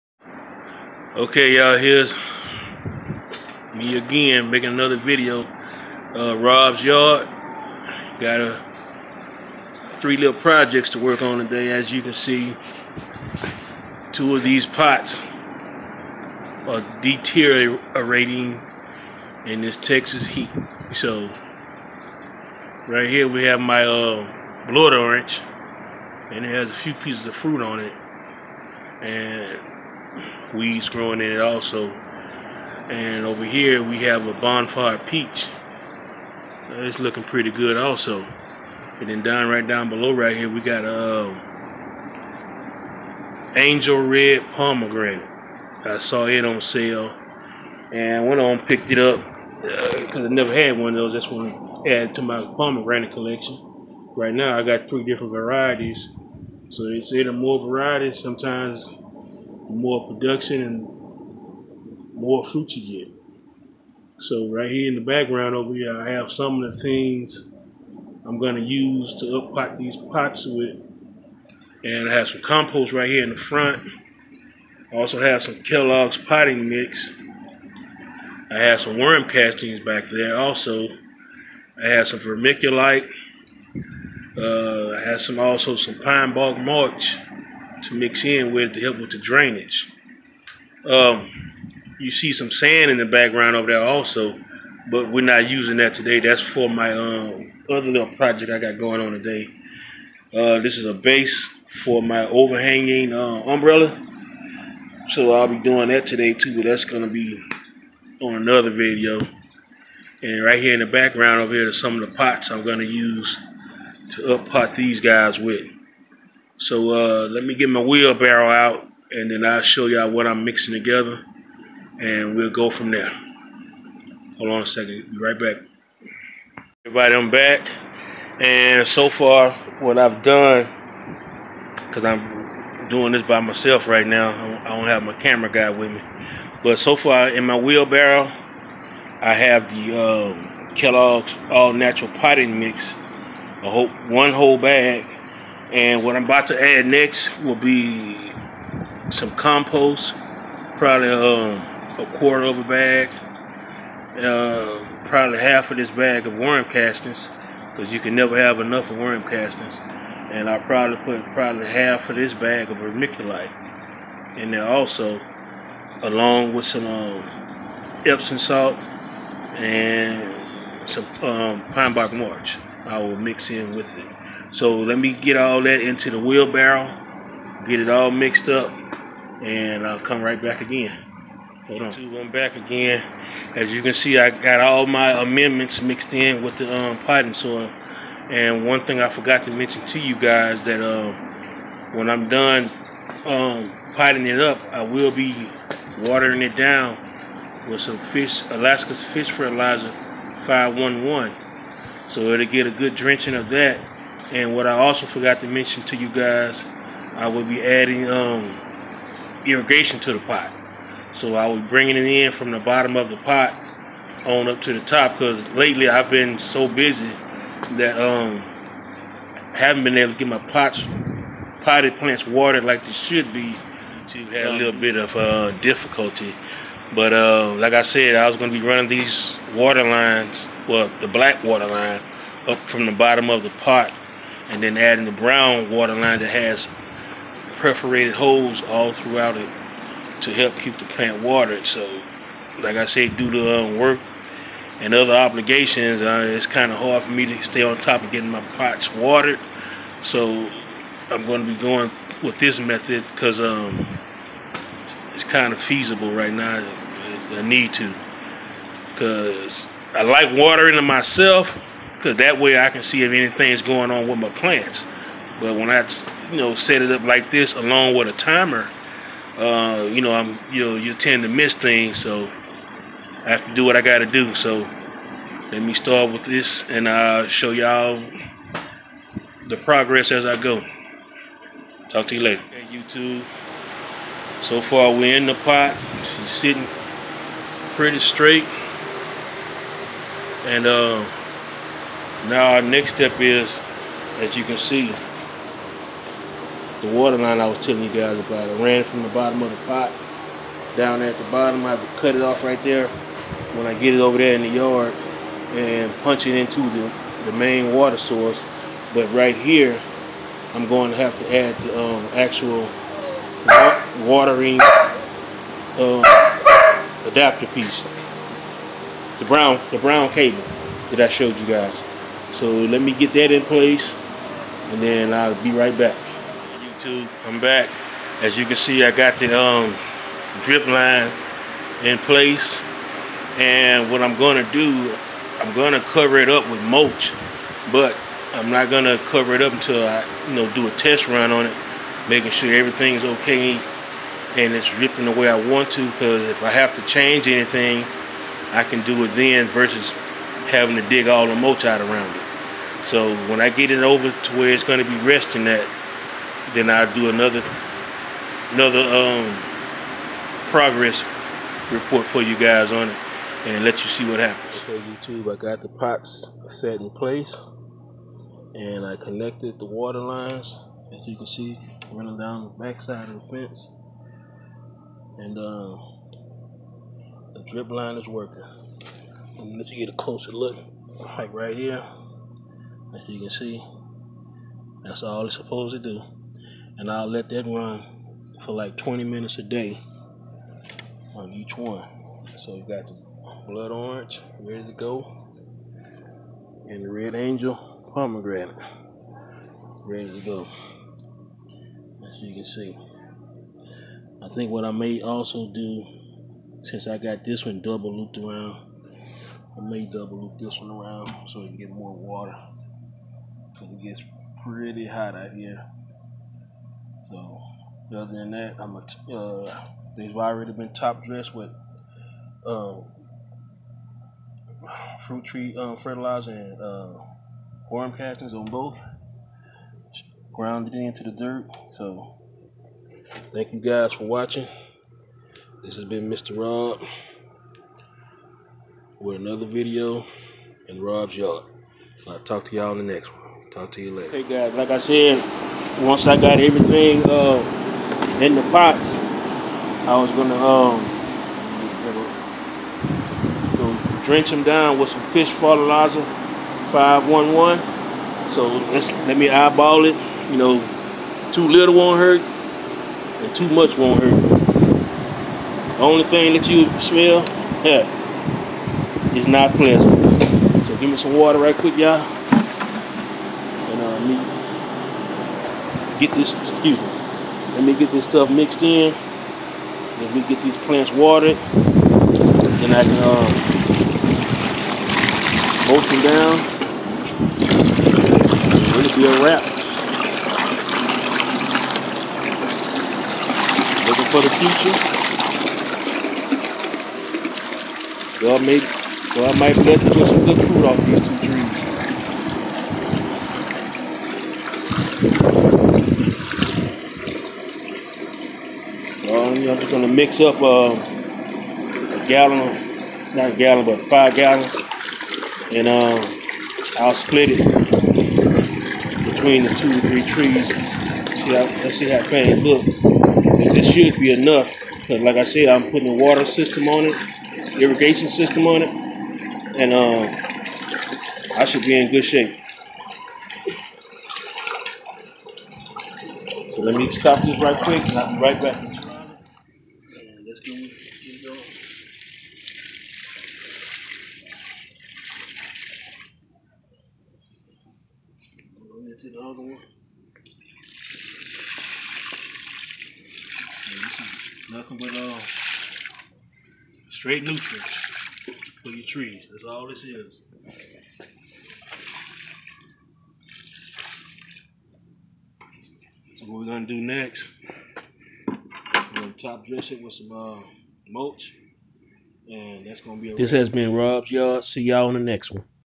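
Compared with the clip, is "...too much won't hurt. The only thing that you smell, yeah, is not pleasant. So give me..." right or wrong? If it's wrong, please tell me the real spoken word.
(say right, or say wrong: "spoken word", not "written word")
right.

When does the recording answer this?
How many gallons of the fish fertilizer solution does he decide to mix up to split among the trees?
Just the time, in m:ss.
8:33.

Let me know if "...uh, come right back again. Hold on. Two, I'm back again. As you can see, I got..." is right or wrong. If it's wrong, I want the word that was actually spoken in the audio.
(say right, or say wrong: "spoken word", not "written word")
right.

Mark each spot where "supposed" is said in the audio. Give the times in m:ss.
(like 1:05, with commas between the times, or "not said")
6:25.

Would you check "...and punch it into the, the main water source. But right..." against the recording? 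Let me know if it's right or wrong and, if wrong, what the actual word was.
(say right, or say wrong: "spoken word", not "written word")
right.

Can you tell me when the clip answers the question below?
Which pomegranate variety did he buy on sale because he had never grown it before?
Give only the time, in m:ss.
0:43.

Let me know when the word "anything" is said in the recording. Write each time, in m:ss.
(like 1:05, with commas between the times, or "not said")
4:23, 5:47.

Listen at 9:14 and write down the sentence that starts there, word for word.
Nothing but uh, straight nutrients for your trees.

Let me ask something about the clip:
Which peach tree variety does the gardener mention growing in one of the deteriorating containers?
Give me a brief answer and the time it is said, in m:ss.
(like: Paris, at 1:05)
Bonfire peach, at 0:34.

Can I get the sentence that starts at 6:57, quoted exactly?
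So, other than that, I'm a.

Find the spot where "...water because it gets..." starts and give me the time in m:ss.
6:51.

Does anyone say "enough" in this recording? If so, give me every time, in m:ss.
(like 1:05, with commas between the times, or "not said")
2:38, 8:44.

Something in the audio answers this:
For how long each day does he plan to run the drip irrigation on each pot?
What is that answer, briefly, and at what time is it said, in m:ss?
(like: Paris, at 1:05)
20 minutes, at 6:28.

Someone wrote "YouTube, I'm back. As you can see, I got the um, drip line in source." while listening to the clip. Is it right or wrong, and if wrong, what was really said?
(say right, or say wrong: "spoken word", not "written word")
wrong: "place", not "source".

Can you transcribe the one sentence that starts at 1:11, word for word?
And I have some compost right here in the front.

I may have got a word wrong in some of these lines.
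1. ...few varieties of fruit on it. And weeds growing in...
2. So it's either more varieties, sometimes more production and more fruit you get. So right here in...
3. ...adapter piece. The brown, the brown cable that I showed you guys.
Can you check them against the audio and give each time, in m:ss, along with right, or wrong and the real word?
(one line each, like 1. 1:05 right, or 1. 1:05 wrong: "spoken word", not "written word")
1. 0:26 wrong: "pieces", not "varieties"
2. 0:56 right
3. 5:17 right.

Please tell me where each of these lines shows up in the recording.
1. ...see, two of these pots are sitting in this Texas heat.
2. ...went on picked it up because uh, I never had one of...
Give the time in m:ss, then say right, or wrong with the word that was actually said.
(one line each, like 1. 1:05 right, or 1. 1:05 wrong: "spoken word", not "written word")
1. 0:12 wrong: "deteriorating", not "sitting"
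2. 0:48 right.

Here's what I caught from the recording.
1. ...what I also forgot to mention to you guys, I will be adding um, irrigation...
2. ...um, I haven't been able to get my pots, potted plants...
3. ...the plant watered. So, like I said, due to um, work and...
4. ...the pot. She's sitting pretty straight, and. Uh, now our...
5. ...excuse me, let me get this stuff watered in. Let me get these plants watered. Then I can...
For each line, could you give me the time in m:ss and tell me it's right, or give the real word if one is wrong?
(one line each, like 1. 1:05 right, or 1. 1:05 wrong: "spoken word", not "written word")
1. 3:24 right
2. 3:37 right
3. 4:00 right
4. 4:45 right
5. 7:56 wrong: "mixed", not "watered".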